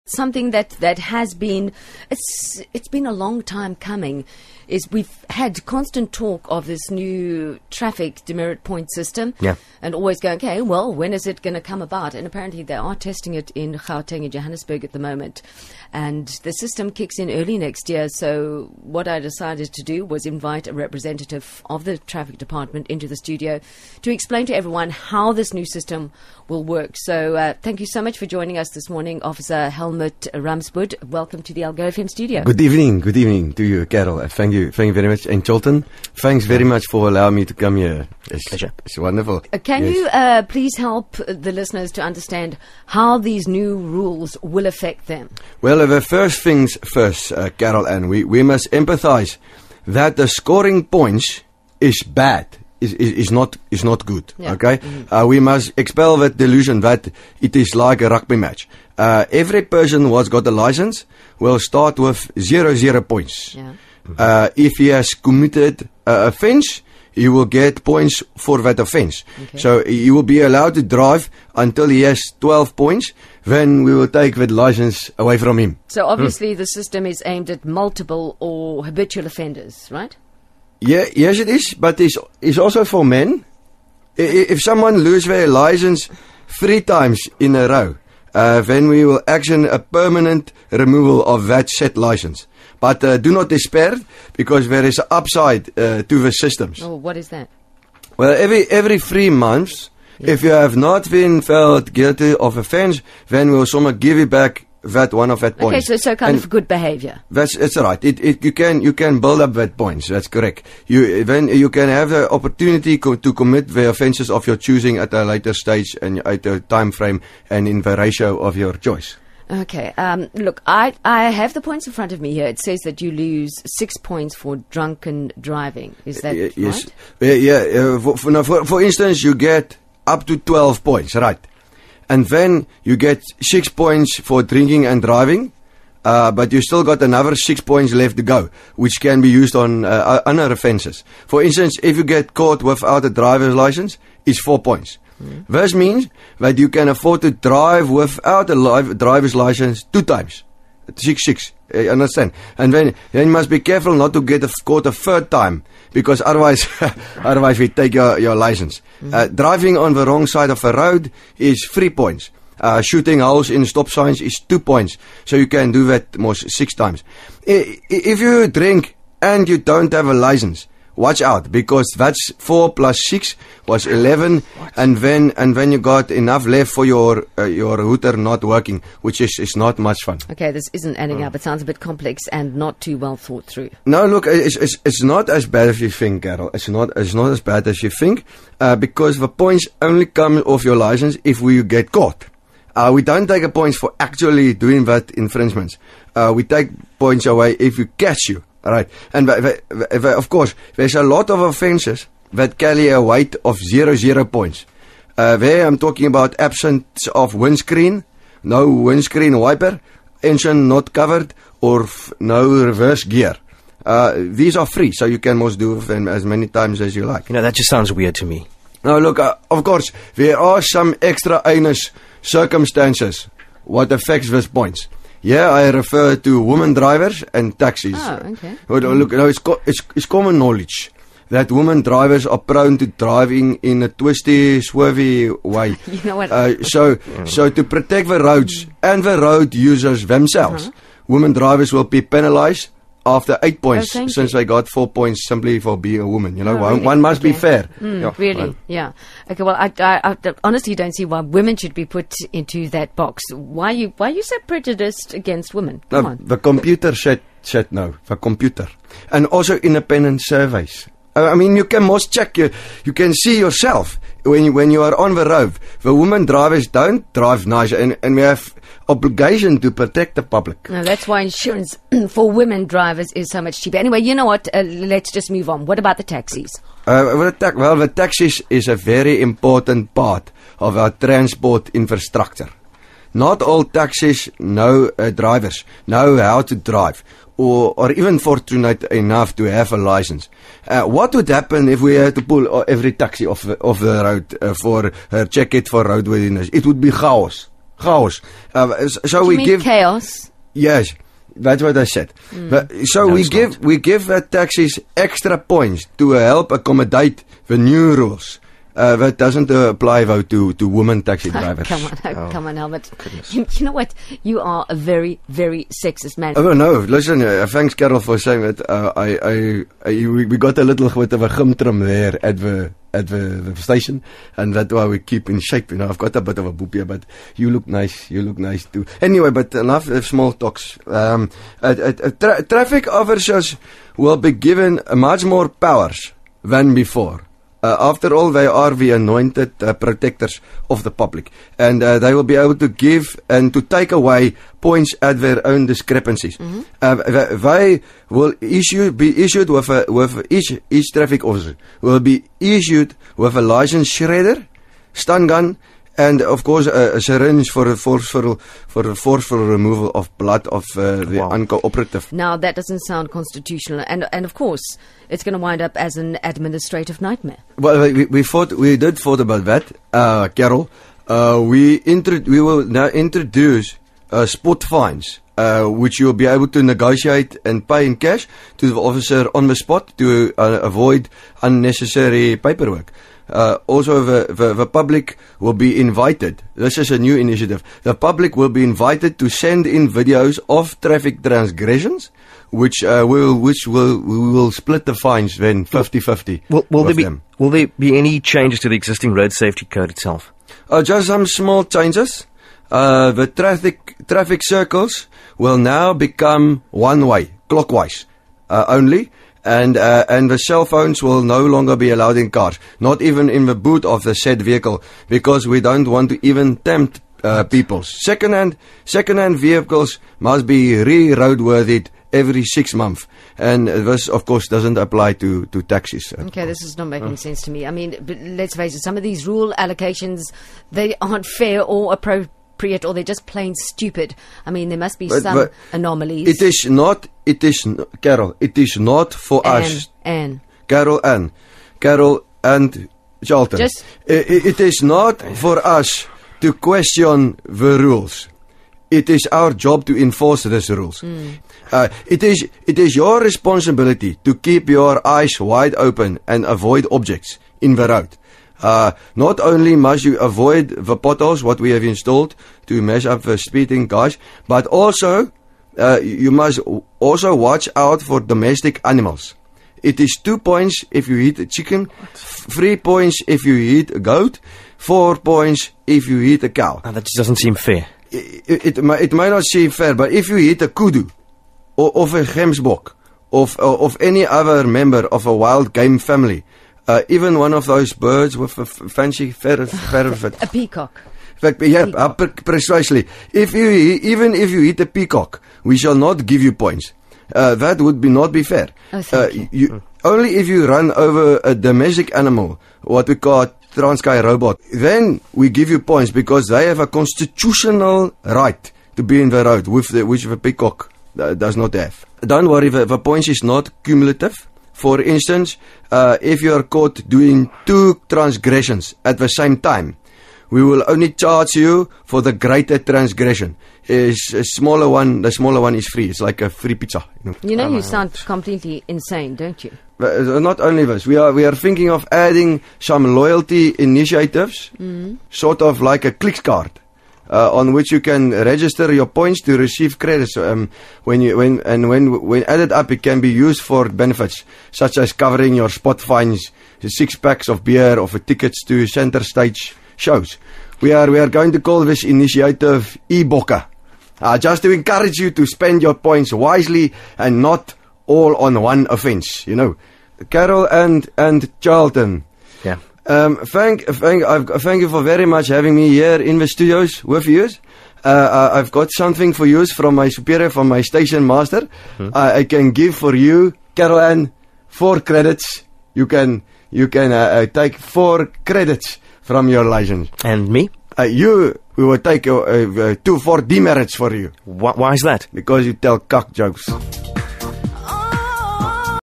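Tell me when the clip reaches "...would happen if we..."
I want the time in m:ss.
4:51.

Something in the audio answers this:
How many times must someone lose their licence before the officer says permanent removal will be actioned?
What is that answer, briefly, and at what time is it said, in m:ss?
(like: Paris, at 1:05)
3, at 1:26.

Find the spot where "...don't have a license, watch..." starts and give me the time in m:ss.
2:49.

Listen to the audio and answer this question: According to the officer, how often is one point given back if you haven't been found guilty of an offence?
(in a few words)
Every 3 months.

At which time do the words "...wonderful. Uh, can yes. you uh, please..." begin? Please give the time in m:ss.
0:38.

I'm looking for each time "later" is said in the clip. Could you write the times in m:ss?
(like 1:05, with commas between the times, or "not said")
1:55.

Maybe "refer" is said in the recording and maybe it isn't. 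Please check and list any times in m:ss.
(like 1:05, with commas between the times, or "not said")
3:45.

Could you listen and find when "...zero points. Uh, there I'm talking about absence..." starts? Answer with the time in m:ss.
3:23.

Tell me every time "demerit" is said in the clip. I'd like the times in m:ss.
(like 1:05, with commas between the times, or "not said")
0:08, 9:43.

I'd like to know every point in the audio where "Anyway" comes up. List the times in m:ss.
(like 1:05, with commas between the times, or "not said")
4:33, 5:29.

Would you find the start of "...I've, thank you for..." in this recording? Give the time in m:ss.
9:24.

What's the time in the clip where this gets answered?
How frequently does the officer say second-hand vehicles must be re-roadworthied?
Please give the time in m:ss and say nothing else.
7:02.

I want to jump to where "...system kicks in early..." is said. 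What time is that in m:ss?
0:16.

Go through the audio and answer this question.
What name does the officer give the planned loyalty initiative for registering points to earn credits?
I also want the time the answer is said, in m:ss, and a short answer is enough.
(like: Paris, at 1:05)
Iboka, at 9:13.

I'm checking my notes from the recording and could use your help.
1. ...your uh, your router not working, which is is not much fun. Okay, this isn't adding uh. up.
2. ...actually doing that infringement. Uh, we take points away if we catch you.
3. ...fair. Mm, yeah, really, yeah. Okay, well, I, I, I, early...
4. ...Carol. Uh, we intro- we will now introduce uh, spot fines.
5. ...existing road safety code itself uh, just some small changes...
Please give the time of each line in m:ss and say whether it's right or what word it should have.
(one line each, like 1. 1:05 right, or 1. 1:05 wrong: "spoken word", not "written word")
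1. 2:56 right
2. 3:13 right
3. 4:07 wrong: "honestly", not "early"
4. 6:10 right
5. 6:38 right.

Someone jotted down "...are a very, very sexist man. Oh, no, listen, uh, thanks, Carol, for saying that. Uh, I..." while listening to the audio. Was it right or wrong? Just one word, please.
right.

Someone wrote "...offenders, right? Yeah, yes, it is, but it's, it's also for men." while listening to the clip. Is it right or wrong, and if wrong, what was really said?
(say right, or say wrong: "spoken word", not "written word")
right.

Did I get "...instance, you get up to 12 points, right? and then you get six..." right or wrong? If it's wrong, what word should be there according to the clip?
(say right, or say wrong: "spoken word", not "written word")
right.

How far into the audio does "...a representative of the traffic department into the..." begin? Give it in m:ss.
0:20.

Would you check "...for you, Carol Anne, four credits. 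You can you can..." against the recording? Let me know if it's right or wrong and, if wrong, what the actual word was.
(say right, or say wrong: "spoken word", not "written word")
right.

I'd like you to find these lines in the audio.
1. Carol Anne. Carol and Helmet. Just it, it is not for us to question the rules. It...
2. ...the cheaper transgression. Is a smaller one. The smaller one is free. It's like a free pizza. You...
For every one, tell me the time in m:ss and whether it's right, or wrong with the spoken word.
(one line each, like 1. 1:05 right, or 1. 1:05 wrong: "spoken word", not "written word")
1. 7:20 wrong: "Charlton", not "Helmet"
2. 8:42 wrong: "greater", not "cheaper".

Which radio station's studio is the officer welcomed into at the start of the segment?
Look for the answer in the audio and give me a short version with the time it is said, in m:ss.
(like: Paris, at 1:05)
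Algoa FM, at 0:31.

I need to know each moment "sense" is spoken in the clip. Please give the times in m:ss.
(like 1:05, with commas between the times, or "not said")
7:07.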